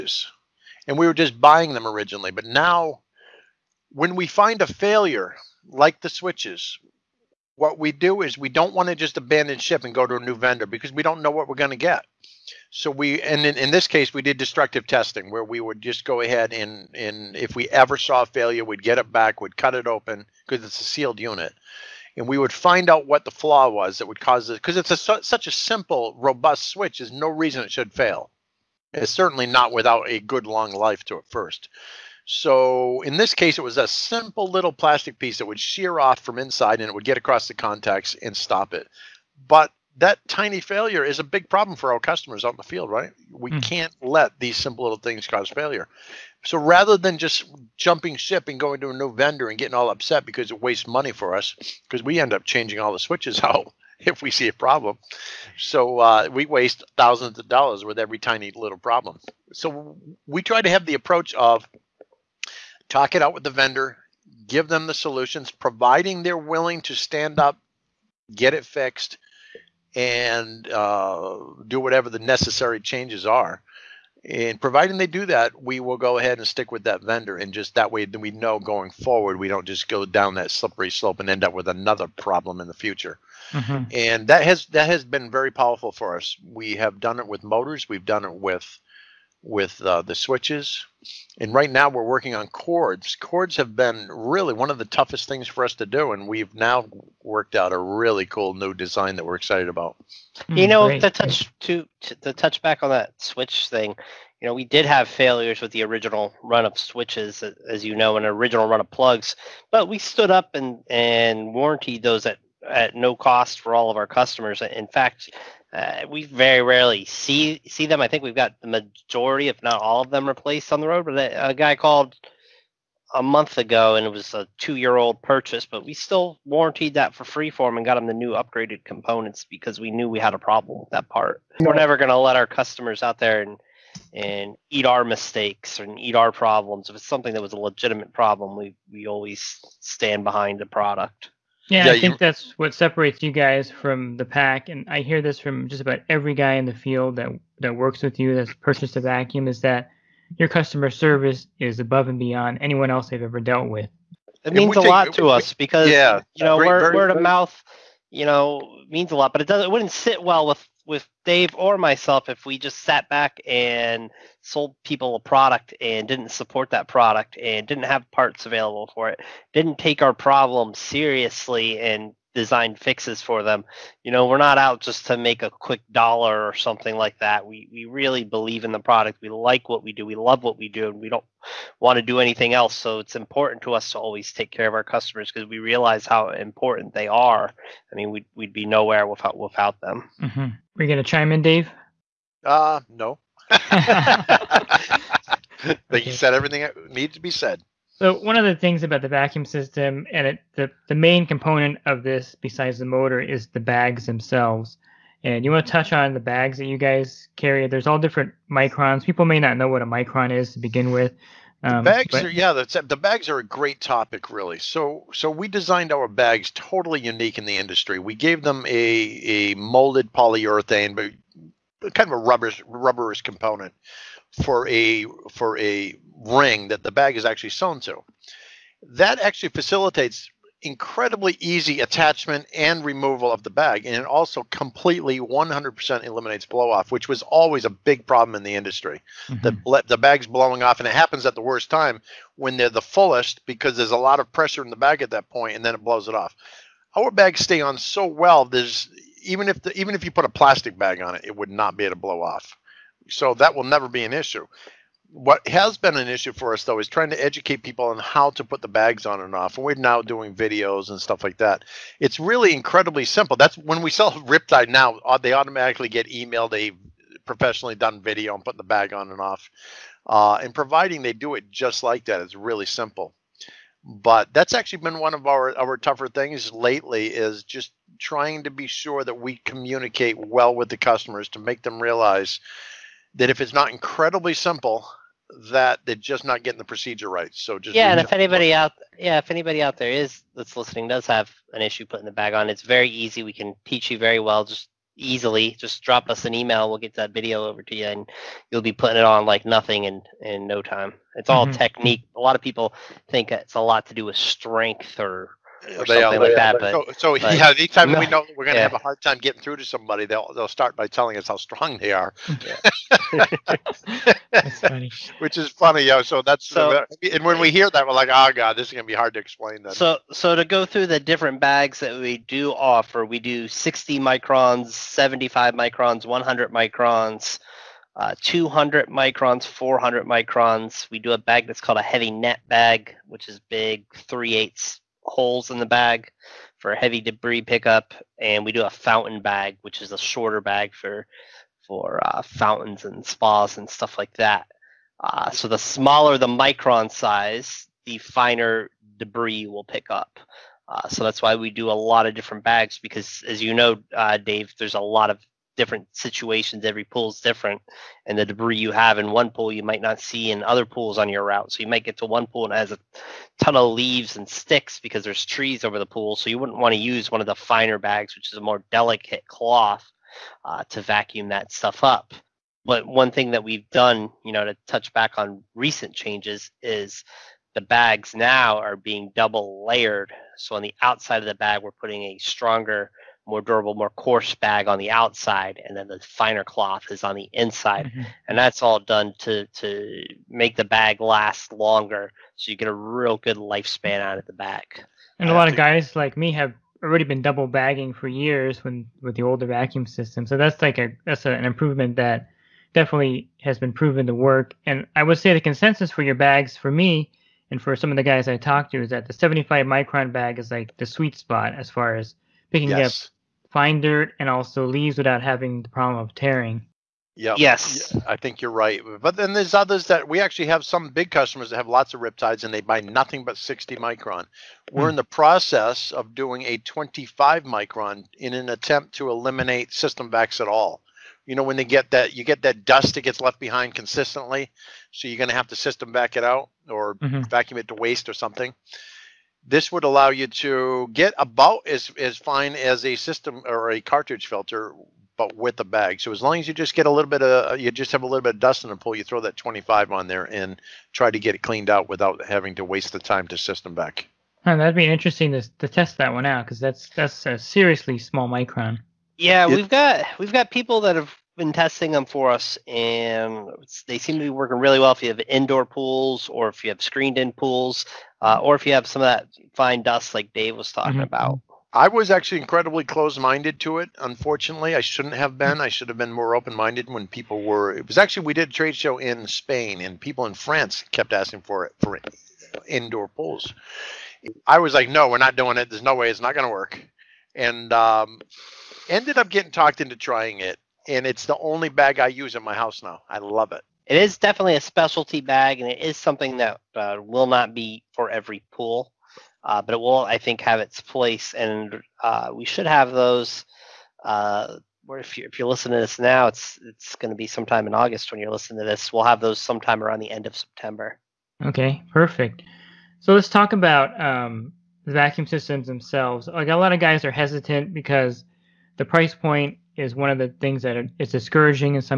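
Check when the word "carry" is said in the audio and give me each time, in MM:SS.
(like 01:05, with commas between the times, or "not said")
03:27.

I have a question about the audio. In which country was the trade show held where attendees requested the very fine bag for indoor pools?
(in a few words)
Spain.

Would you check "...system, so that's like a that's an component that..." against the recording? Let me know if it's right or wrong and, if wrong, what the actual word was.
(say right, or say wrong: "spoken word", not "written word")
wrong: "improvement", not "component".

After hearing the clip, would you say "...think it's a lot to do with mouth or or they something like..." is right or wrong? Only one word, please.
wrong.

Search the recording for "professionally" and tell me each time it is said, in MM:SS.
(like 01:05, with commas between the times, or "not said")
04:27.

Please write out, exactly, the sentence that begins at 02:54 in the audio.
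You know, we're not out just to make a quick dollar or something like that.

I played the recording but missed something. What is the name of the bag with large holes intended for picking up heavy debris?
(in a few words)
heavy net bag.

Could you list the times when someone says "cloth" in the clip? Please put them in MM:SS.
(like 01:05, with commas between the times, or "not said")
06:09, 06:26.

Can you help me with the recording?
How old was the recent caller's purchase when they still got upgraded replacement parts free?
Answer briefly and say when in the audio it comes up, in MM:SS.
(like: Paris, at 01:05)
two-year-old, at 02:04.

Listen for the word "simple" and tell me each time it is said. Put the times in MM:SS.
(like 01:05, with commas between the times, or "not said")
00:25, 00:33, 00:44, 04:23, 04:32, 04:44.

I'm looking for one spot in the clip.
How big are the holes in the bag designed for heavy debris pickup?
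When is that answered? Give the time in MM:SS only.
05:34.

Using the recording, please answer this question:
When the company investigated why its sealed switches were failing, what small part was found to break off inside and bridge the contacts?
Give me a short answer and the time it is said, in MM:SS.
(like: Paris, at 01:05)
plastic piece, at 00:34.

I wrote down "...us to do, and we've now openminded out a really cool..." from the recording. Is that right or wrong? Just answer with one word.
wrong.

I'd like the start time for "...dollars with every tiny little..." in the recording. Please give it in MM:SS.
00:57.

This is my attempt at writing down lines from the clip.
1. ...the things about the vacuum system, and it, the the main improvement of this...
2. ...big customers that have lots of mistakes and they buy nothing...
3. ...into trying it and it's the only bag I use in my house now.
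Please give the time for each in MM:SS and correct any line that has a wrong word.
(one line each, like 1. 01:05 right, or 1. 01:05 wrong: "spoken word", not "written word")
1. 03:18 wrong: "component", not "improvement"
2. 07:00 wrong: "riptides", not "mistakes"
3. 08:09 right.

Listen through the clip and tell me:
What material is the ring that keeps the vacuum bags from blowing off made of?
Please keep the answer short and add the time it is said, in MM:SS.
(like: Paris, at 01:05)
molded polyurethane, at 03:39.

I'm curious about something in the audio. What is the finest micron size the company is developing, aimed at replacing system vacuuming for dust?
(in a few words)
25 micron.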